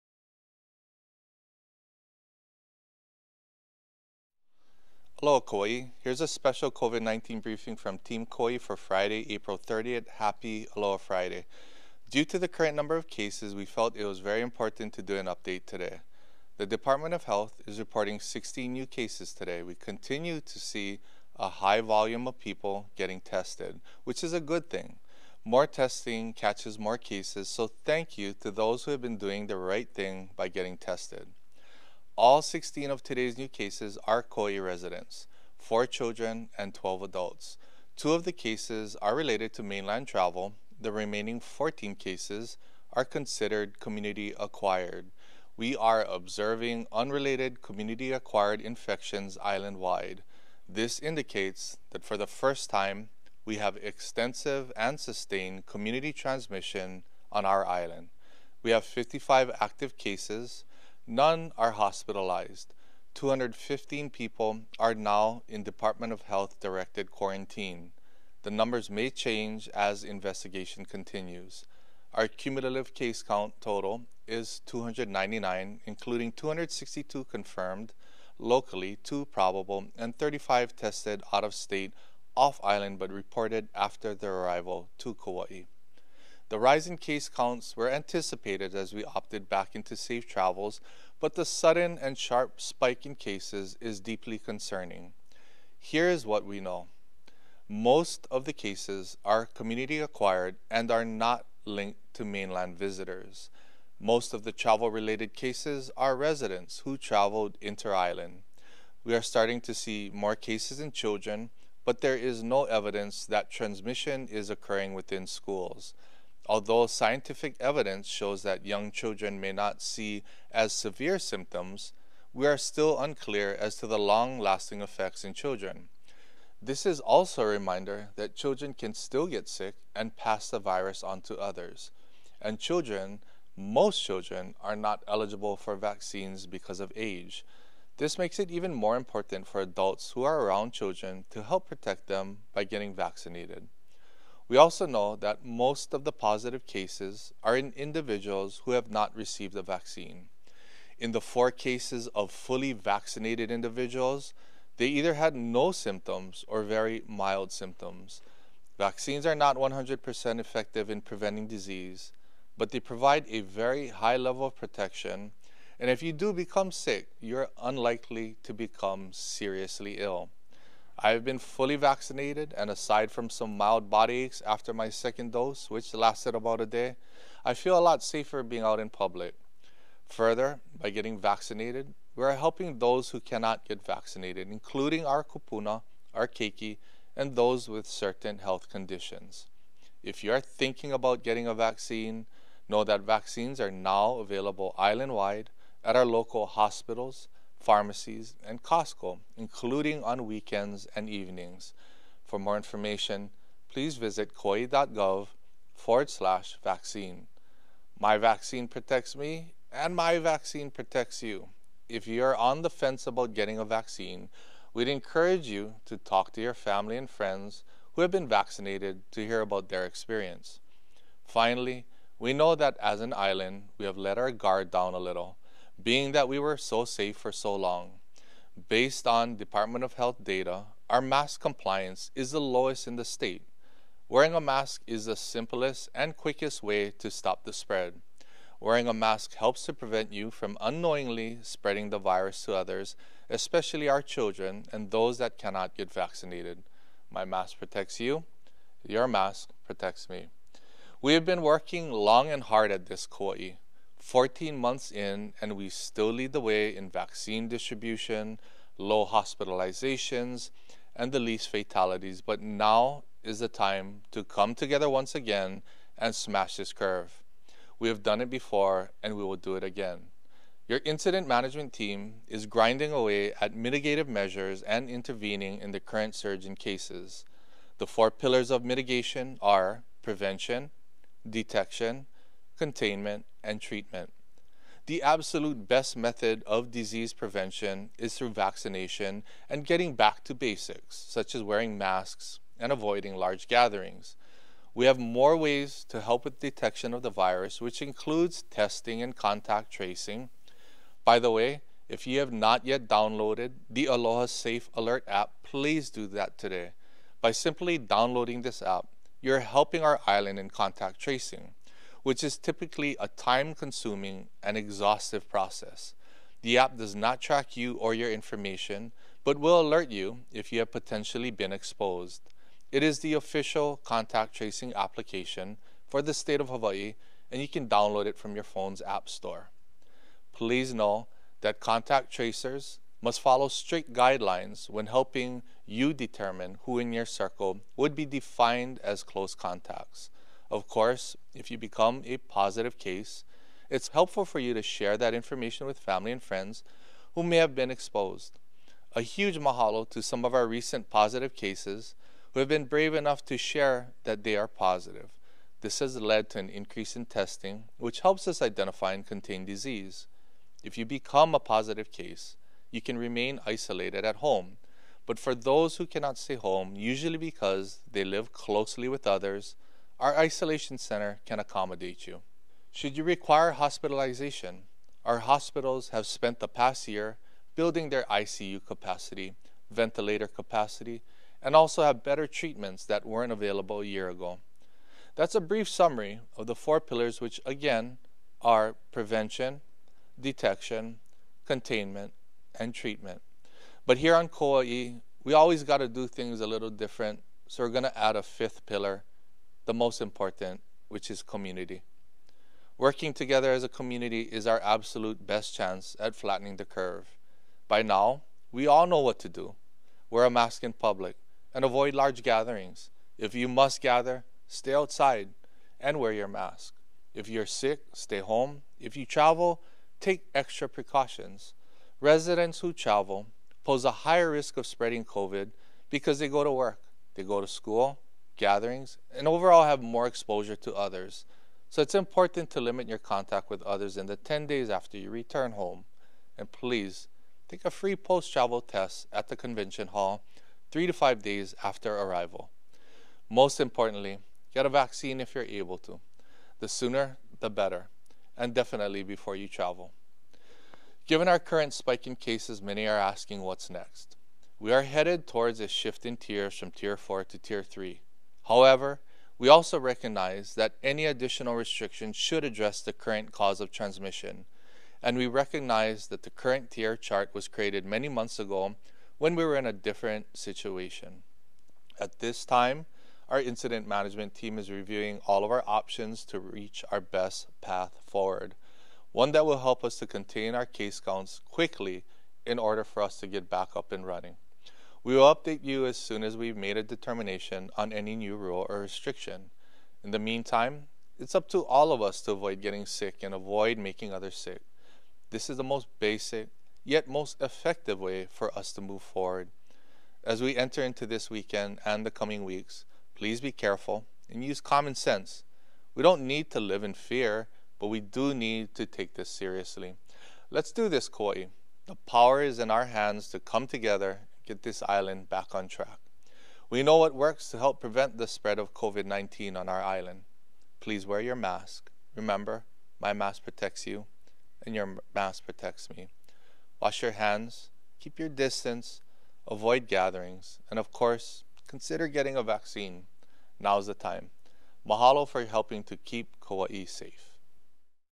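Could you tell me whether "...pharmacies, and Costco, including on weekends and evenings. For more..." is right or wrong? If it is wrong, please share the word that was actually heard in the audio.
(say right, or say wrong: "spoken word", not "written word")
right.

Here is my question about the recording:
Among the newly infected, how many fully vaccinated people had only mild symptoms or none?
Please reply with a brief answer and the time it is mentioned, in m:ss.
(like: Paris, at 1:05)
4, at 2:31.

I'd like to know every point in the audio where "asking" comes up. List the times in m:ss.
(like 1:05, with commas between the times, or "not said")
7:33.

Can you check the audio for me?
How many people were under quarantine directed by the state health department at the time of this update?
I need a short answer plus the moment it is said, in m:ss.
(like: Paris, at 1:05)
215, at 1:03.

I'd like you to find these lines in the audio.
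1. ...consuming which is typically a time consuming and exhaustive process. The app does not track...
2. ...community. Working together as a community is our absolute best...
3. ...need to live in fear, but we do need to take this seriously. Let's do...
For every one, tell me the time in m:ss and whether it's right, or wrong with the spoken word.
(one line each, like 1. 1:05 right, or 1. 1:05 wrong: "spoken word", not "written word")
1. 5:10 wrong: "tracing", not "consuming"
2. 6:41 right
3. 8:26 right.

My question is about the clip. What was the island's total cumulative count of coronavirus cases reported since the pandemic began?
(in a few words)
299.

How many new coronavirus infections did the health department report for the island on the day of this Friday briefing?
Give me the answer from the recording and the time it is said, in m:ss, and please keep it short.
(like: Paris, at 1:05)
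16, at 0:18.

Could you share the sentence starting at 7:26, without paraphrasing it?
The sooner, the better, and definitely before you travel.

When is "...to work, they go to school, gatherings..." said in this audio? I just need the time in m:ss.
7:06.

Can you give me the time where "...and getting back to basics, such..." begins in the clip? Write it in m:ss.
4:49.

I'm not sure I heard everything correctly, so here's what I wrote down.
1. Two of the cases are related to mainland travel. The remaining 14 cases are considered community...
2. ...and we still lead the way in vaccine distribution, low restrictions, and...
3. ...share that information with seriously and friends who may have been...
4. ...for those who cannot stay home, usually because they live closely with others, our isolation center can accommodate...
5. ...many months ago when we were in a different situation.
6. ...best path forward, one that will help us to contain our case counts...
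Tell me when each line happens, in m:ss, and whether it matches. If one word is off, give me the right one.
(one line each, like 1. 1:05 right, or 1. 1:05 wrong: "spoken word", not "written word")
1. 0:37 right
2. 4:15 wrong: "hospitalizations", not "restrictions"
3. 5:44 wrong: "family", not "seriously"
4. 6:05 right
5. 7:47 right
6. 7:56 right.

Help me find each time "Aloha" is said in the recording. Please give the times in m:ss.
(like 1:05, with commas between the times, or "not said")
0:10, 5:03.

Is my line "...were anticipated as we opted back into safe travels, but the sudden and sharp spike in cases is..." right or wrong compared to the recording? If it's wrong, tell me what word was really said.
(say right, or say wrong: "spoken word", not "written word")
right.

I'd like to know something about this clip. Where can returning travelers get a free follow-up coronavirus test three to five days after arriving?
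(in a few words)
The convention hall.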